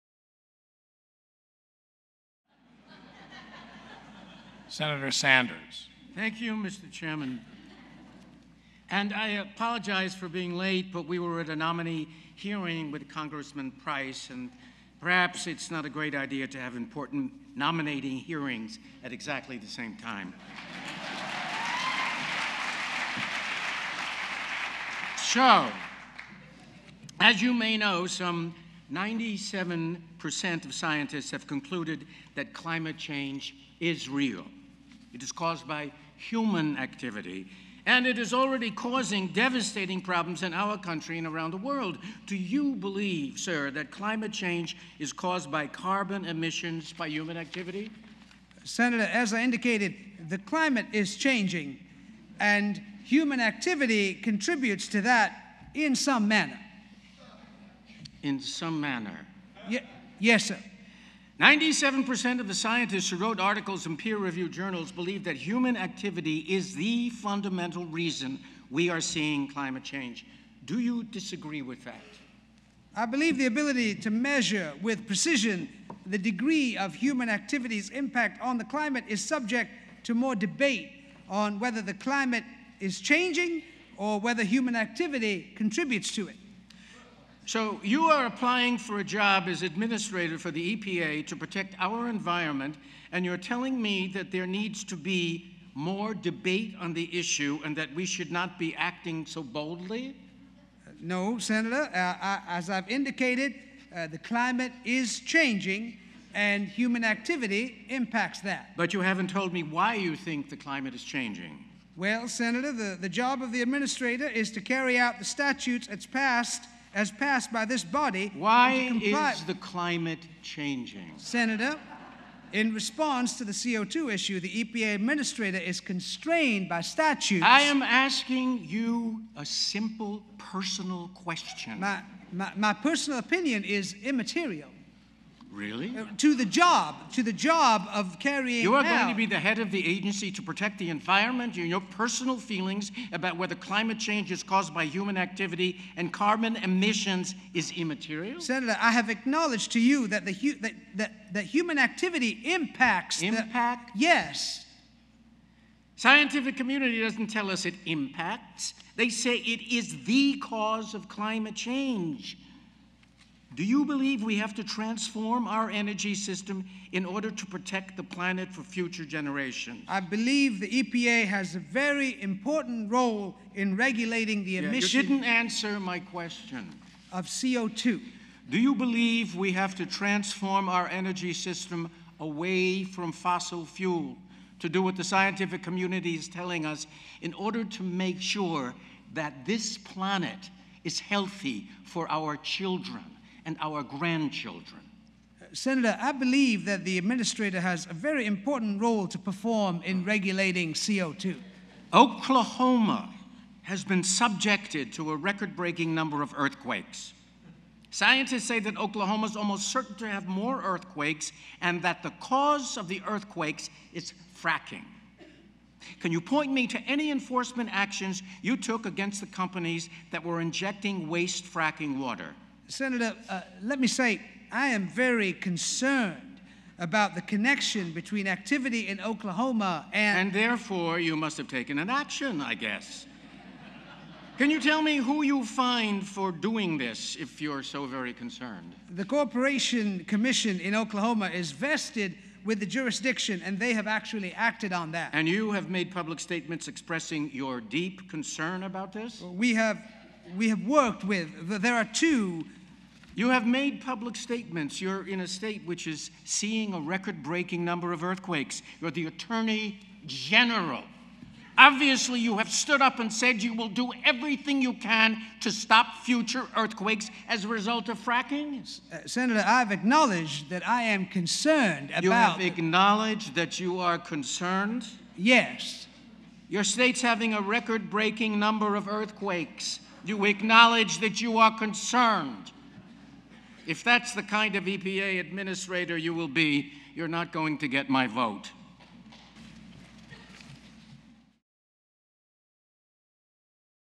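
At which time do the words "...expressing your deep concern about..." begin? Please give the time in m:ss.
4:06.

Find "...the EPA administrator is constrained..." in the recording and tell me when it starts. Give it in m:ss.
2:04.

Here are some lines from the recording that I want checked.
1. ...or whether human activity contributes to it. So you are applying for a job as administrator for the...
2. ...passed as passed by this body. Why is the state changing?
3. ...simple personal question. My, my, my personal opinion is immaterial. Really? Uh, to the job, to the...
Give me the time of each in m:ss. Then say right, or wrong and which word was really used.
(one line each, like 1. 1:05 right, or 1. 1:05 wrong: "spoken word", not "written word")
1. 1:23 right
2. 1:56 wrong: "climate", not "state"
3. 2:09 right.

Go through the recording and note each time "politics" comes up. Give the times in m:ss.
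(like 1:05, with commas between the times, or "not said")
not said.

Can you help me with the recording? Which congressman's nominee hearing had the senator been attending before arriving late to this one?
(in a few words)
Congressman Price.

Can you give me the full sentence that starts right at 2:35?
Scientific community doesn't tell us it impacts.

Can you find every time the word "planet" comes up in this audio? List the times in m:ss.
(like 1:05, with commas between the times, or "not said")
2:48, 3:09.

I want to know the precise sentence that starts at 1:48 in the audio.
But you haven't told me why you think the climate is changing.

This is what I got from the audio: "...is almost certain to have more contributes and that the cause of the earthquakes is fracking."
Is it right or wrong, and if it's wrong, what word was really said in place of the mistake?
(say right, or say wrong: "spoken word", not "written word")
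wrong: "earthquakes", not "contributes".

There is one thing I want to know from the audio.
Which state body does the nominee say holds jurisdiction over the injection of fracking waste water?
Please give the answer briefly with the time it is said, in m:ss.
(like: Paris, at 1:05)
The Corporation Commission, at 3:58.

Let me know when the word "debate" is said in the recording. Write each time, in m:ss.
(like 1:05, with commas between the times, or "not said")
1:20, 1:36.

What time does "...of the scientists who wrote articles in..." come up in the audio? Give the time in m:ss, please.
1:02.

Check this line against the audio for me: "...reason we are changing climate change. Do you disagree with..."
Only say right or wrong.
wrong.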